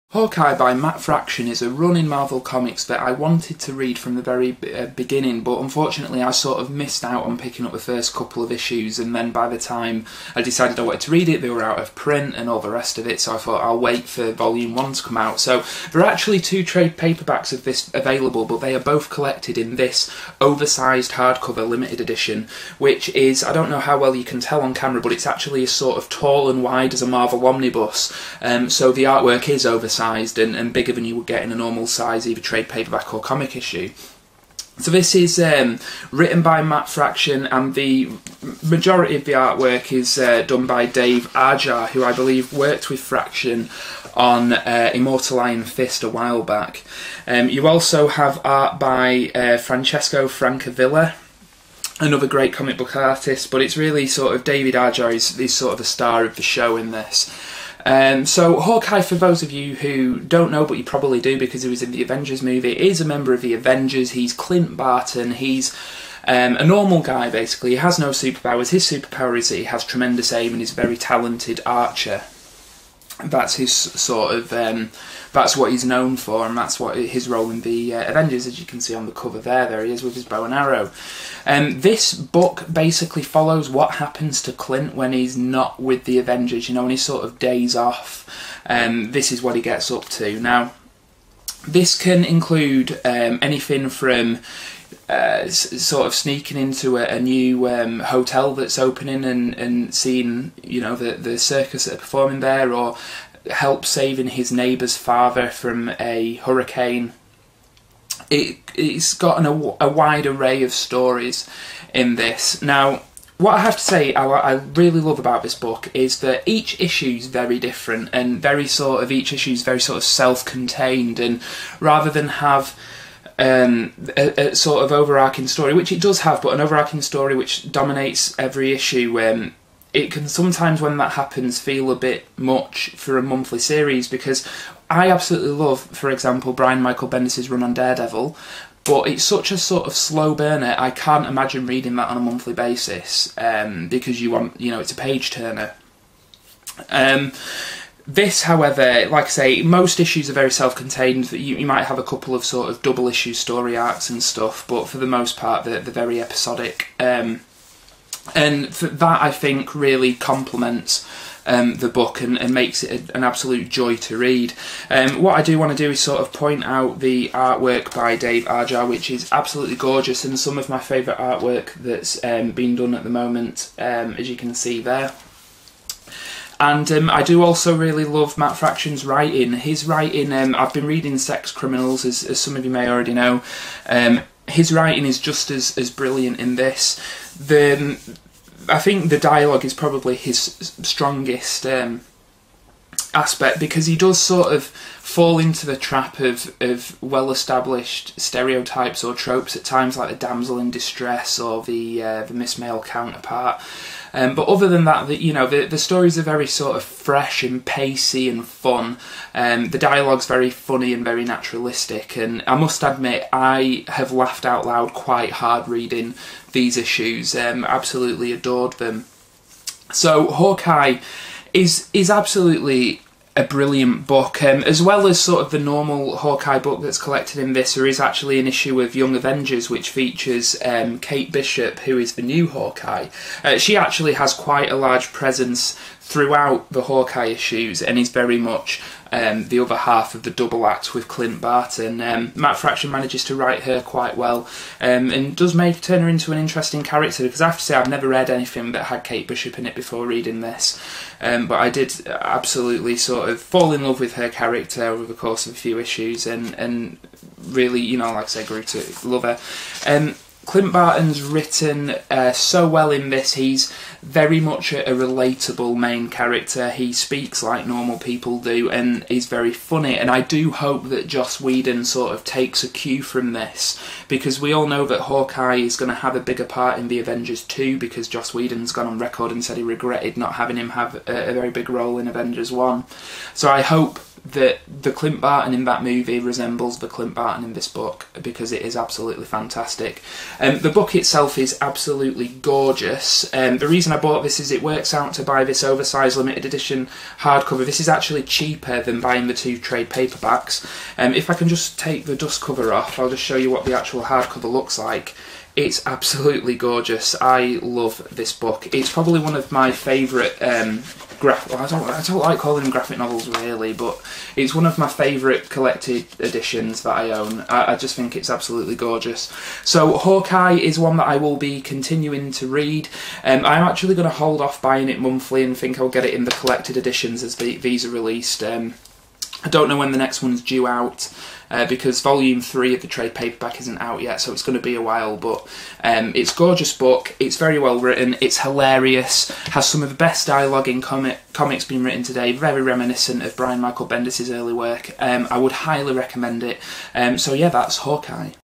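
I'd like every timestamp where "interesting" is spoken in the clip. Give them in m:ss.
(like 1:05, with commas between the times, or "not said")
4:06.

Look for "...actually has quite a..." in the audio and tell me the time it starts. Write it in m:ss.
3:53.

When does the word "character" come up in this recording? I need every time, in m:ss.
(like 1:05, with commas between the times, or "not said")
4:06, 4:14, 4:26.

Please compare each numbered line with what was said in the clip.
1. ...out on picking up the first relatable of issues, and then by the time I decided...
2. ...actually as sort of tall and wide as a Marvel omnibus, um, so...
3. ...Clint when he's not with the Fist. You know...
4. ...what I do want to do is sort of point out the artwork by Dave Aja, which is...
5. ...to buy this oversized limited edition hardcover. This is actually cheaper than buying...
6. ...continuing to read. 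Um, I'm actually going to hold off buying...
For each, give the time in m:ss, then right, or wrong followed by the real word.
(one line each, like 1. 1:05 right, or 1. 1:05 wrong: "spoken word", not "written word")
1. 0:07 wrong: "couple", not "relatable"
2. 0:25 right
3. 1:24 wrong: "Avengers", not "Fist"
4. 2:45 right
5. 4:55 right
6. 5:21 right.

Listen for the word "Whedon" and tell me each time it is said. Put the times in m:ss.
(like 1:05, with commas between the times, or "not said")
4:31, 4:38.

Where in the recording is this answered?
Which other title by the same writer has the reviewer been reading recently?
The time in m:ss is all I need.
3:01.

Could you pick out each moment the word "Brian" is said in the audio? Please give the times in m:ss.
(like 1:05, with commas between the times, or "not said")
2:16, 5:43.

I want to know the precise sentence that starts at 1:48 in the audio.
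It it's got an, a, a wide array of stories in this now.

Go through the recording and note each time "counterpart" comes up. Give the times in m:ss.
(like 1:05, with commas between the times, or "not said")
3:22.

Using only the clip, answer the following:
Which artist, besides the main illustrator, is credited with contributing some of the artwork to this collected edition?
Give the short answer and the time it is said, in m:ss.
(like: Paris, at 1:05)
Francesco Francavilla, at 0:49.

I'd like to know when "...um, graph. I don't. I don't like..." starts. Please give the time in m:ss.
5:10.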